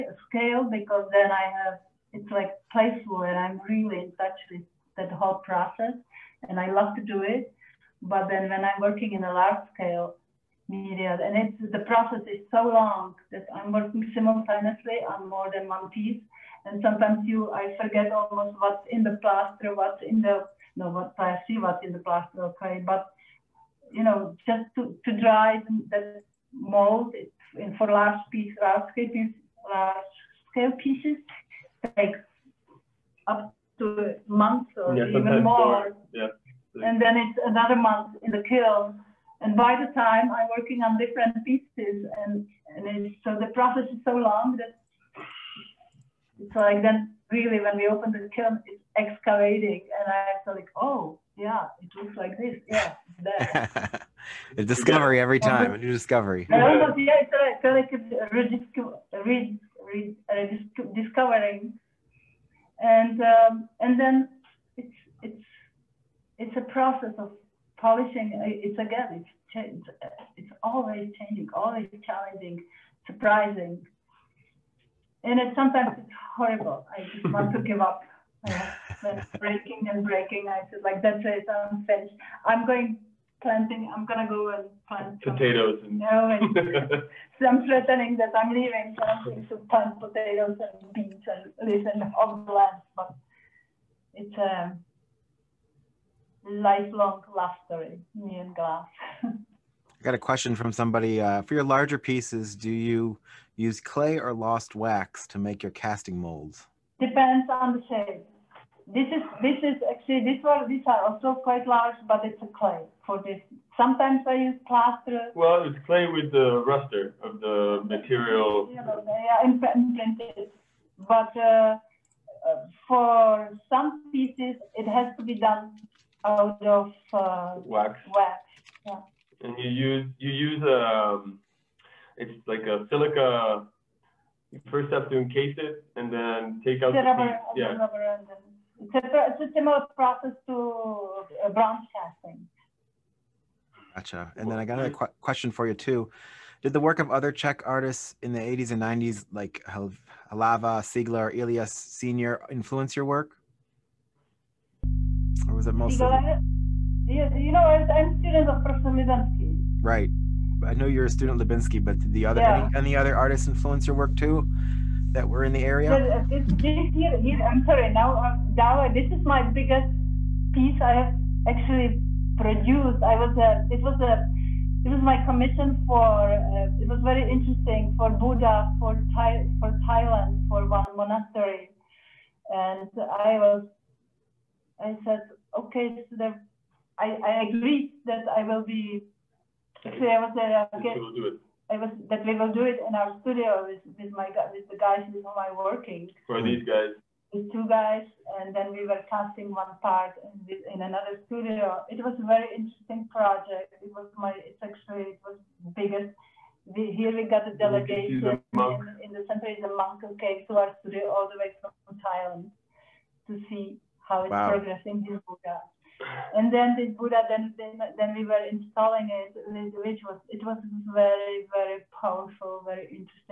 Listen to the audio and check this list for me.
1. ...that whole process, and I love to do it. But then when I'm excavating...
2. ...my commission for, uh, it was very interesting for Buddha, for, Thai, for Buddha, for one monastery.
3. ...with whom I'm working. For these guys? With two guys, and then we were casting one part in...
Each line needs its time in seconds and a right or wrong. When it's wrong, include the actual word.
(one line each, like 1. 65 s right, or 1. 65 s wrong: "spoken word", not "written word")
1. 4 s wrong: "working", not "excavating"
2. 175 s wrong: "Thailand", not "Buddha"
3. 195 s right.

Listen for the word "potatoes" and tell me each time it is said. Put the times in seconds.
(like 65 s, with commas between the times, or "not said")
85 s, 90 s.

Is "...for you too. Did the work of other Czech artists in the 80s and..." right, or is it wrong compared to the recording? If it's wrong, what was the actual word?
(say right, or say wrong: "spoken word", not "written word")
right.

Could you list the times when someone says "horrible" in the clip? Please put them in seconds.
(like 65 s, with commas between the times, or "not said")
76 s.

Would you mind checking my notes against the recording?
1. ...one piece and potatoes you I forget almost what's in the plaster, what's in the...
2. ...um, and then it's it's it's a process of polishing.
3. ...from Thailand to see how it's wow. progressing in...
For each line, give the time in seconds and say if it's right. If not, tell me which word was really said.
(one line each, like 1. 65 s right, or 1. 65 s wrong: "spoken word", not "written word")
1. 15 s wrong: "sometimes", not "potatoes"
2. 63 s right
3. 211 s right.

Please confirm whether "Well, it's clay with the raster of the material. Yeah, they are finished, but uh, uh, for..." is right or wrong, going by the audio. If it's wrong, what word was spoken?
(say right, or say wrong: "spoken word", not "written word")
wrong: "imprinted", not "finished".